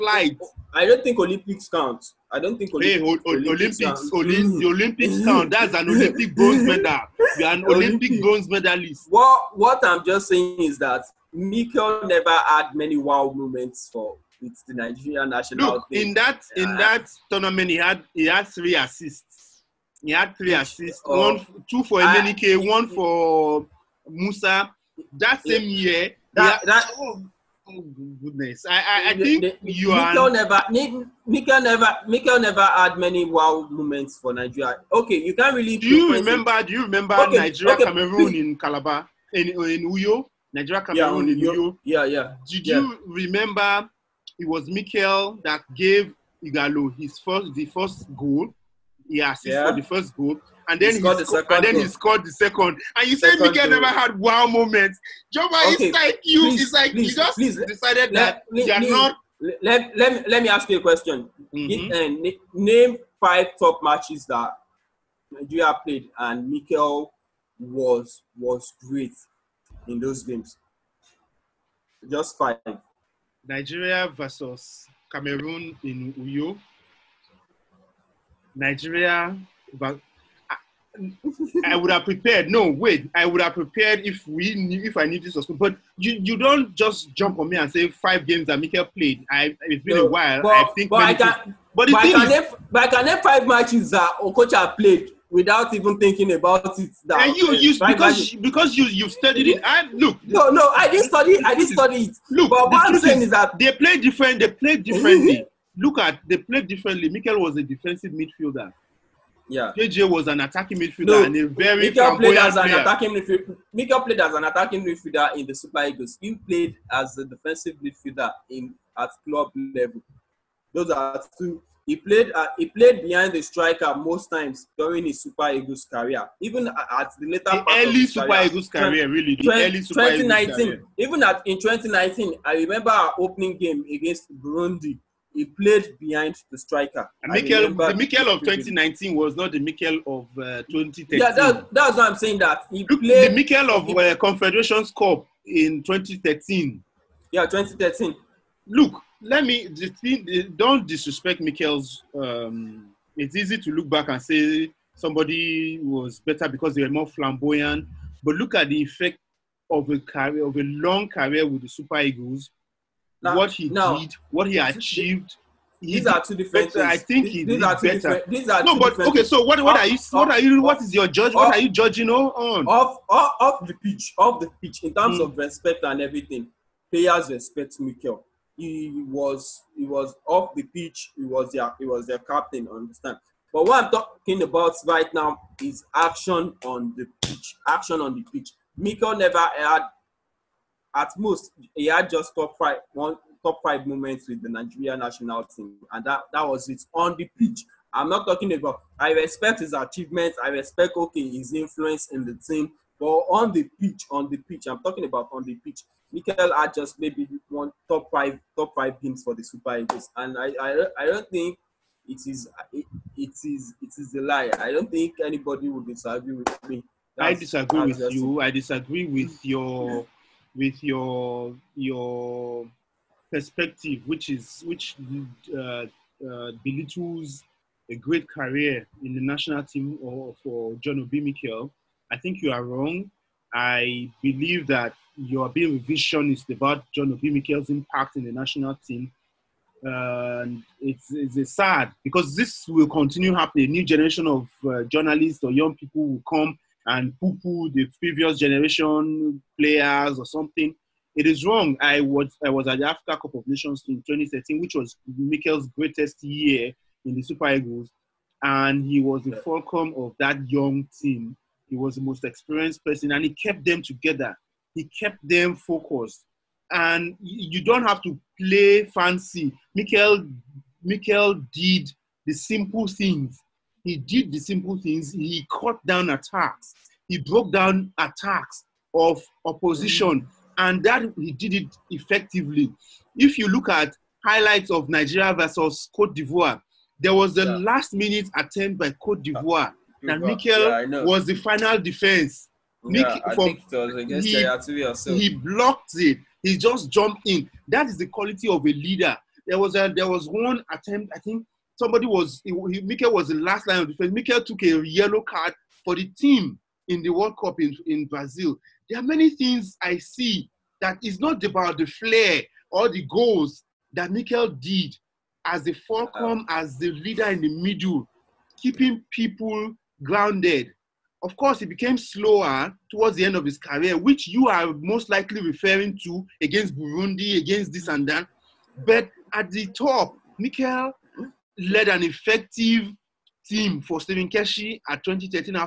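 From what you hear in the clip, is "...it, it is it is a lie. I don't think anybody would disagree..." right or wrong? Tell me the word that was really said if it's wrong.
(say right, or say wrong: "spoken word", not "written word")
right.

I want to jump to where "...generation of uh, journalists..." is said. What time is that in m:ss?
4:03.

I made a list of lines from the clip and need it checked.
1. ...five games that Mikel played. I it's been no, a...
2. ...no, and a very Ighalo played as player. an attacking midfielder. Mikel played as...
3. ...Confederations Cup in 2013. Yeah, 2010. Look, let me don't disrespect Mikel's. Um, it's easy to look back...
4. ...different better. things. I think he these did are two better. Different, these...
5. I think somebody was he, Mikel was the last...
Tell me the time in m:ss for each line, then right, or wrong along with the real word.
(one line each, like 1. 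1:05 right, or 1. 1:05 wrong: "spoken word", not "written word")
1. 1:27 right
2. 1:51 wrong: "Mikel", not "Ighalo"
3. 2:24 wrong: "2013", not "2010"
4. 2:46 right
5. 5:01 right.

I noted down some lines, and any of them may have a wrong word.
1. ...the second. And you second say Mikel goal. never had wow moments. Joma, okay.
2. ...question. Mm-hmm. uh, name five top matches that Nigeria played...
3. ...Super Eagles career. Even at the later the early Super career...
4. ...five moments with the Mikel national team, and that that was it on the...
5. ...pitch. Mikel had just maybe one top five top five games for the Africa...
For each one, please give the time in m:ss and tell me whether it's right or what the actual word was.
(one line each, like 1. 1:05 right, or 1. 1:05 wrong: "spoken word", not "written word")
1. 0:52 right
2. 1:00 right
3. 2:05 right
4. 3:13 wrong: "Nigeria", not "Mikel"
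5. 3:25 wrong: "Super", not "Africa".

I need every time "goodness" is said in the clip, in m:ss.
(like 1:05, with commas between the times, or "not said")
0:28.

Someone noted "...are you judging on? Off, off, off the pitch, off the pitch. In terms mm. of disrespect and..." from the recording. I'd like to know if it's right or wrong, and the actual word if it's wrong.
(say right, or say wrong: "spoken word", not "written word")
wrong: "respect", not "disrespect".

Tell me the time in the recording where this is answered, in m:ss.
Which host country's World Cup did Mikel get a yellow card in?
5:08.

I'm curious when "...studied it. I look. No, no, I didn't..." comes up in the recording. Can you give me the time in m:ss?
1:39.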